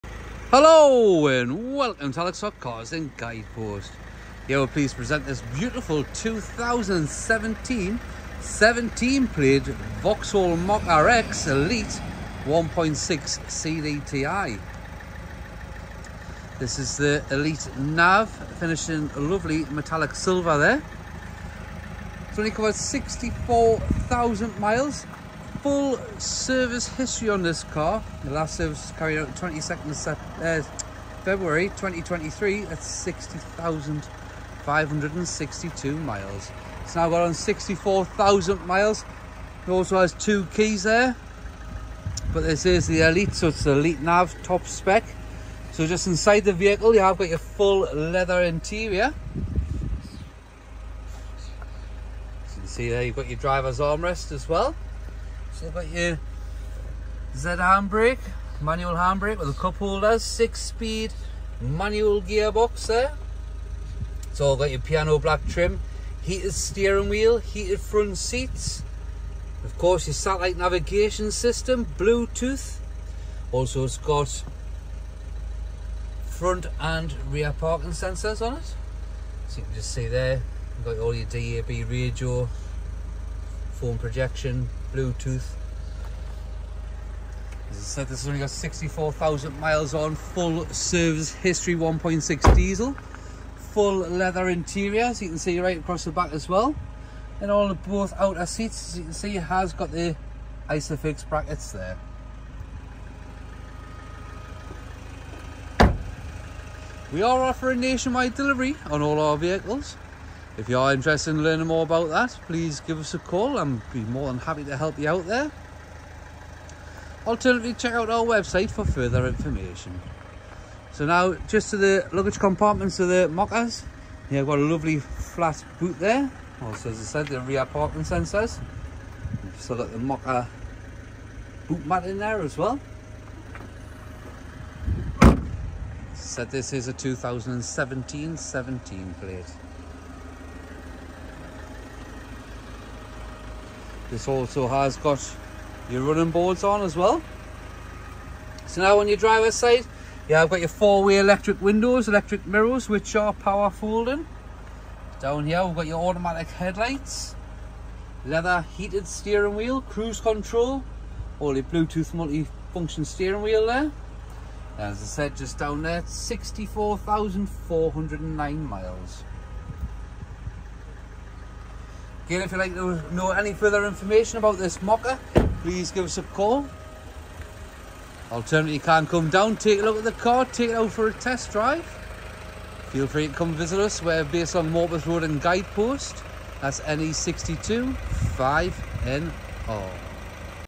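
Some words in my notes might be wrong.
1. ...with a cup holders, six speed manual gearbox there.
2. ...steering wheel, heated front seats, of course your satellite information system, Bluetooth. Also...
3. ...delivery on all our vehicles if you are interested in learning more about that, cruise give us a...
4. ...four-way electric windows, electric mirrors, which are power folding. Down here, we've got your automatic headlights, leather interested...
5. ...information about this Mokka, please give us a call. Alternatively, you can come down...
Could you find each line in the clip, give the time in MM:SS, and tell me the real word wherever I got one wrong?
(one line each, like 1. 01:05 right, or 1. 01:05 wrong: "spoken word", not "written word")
1. 00:59 right
2. 01:06 wrong: "navigation", not "information"
3. 01:48 wrong: "please", not "cruise"
4. 02:30 wrong: "heated", not "interested"
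5. 02:53 right.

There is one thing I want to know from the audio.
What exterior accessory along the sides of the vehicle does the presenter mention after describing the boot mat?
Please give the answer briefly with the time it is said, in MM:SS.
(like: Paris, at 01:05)
Running boards, at 02:26.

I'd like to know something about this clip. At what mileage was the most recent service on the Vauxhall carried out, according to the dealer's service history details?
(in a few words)
60,562.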